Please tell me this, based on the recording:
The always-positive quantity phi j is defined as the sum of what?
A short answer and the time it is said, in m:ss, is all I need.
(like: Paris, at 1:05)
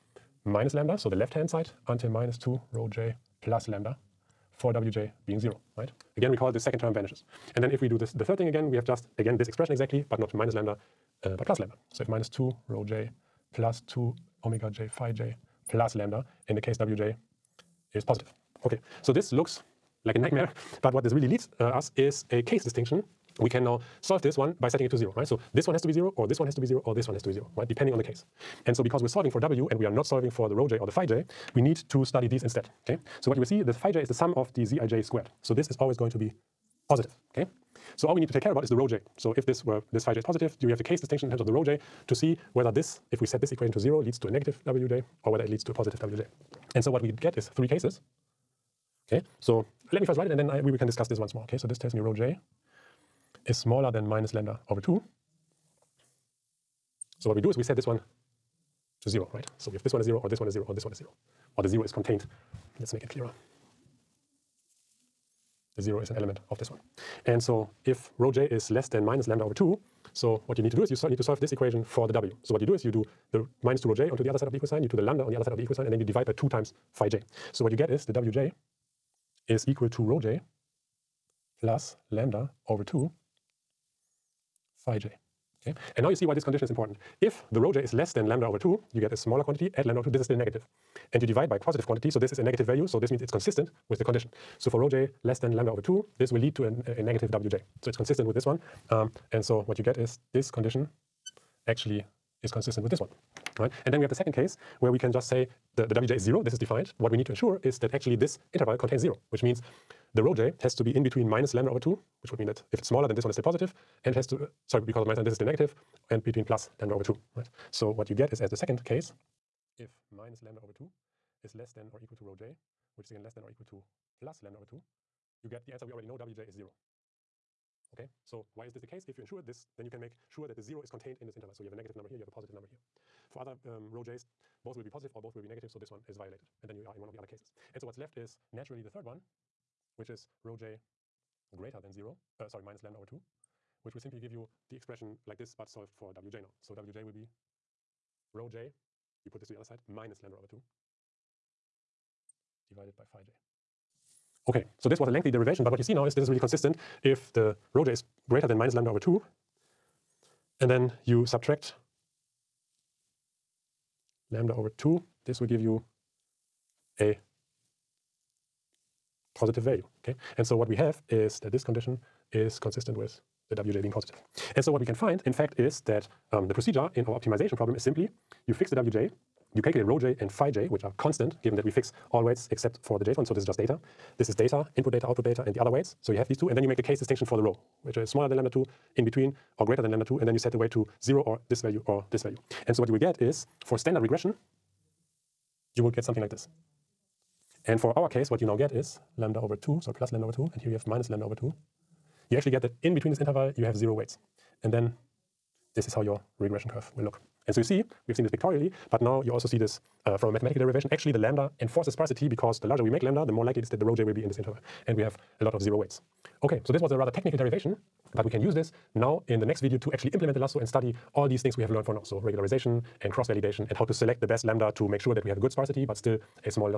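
zij squared, at 0:34.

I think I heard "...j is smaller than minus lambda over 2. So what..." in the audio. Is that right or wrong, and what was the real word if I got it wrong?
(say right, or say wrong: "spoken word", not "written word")
right.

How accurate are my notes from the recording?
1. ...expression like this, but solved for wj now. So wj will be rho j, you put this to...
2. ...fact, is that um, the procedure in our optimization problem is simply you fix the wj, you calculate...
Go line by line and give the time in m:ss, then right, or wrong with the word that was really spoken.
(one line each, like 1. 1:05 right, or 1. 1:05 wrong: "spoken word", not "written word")
1. 2:24 right
2. 2:55 right.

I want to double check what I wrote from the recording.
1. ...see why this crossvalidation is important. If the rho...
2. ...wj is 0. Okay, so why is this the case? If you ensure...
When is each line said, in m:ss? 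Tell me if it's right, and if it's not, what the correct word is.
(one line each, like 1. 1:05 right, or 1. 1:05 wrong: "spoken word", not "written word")
1. 1:26 wrong: "condition", not "crossvalidation"
2. 2:06 right.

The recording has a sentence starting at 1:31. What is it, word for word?
And you divide by a positive quantity, so this is a negative value, so this means it's consistent with the condition.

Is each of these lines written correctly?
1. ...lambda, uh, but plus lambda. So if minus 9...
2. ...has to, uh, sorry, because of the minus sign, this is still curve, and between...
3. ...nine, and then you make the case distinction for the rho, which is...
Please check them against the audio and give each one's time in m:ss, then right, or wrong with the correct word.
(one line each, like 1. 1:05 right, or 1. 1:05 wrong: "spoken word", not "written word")
1. 0:10 wrong: "2", not "9"
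2. 1:54 wrong: "negative", not "curve"
3. 3:06 wrong: "two", not "nine".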